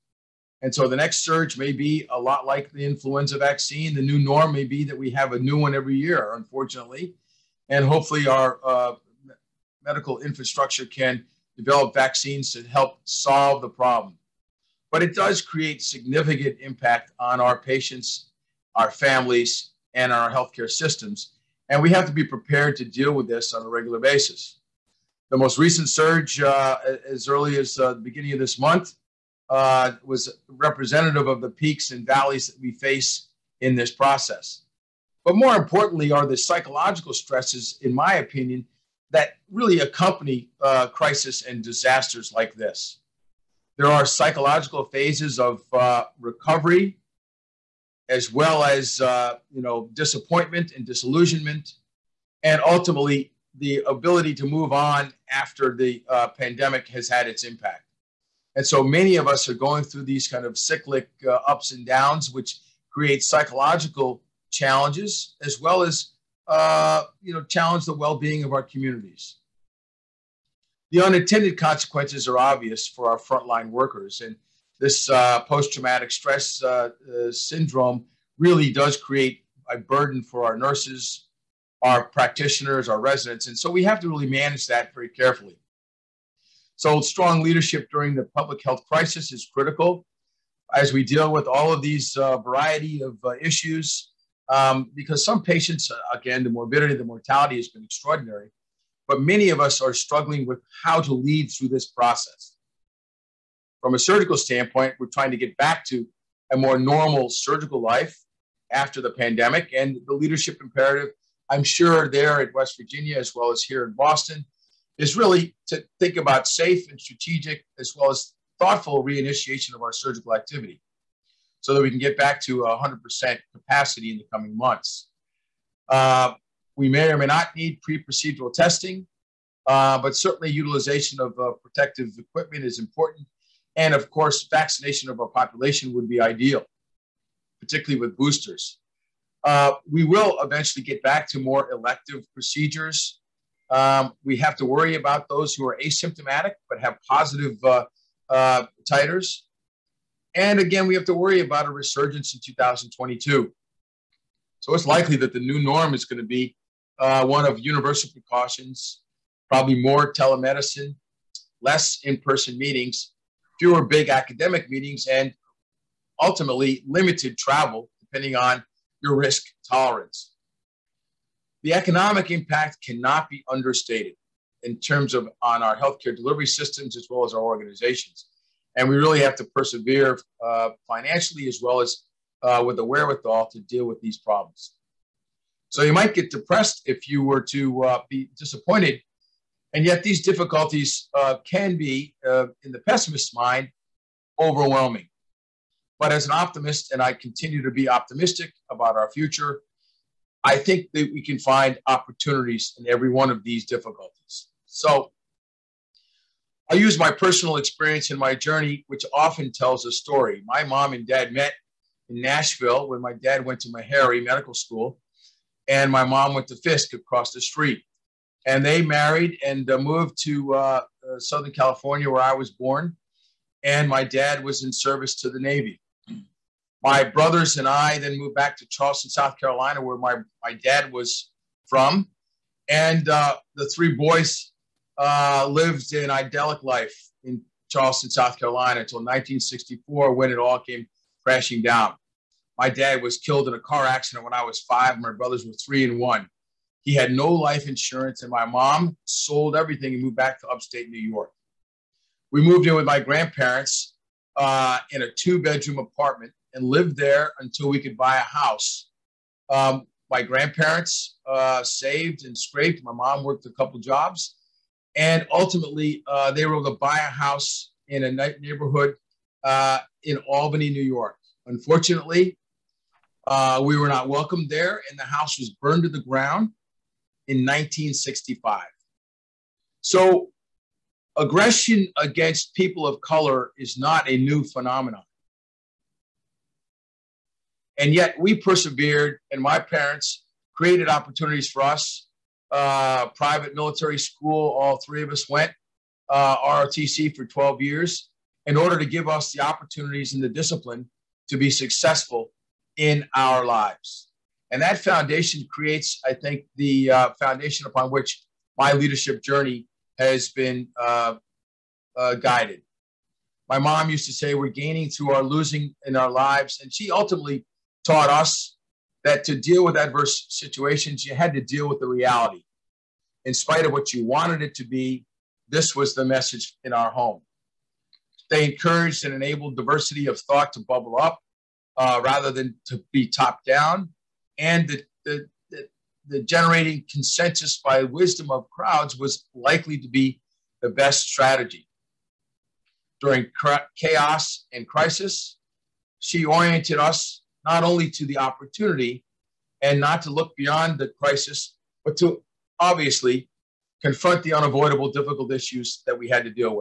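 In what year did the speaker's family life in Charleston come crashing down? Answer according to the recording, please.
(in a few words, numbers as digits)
1964.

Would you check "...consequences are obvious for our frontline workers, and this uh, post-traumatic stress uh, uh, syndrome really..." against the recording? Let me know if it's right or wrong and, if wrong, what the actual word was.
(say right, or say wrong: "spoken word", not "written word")
right.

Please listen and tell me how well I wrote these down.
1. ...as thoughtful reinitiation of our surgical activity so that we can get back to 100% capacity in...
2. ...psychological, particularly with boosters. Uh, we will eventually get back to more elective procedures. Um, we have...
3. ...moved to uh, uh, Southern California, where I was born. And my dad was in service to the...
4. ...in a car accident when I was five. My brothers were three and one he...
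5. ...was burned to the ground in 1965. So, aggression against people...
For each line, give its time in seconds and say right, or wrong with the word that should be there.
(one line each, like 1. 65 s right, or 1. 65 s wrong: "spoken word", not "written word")
1. 118 s right
2. 136 s wrong: "ideal", not "psychological"
3. 219 s right
4. 243 s right
5. 275 s right.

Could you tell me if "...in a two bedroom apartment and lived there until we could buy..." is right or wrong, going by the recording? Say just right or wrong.
right.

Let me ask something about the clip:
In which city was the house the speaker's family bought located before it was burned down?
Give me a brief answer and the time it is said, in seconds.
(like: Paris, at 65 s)
Albany, New York, at 270 s.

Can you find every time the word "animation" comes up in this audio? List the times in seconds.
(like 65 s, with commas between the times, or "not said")
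not said.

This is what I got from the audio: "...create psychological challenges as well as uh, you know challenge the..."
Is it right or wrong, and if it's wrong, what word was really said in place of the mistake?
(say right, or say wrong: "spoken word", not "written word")
right.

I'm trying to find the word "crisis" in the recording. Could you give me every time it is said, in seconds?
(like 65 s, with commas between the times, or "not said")
40 s, 88 s, 344 s, 351 s.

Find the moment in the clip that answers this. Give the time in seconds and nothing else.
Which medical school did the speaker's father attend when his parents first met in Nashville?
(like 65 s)
213 s.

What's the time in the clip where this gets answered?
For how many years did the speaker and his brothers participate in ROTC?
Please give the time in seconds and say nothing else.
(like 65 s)
297 s.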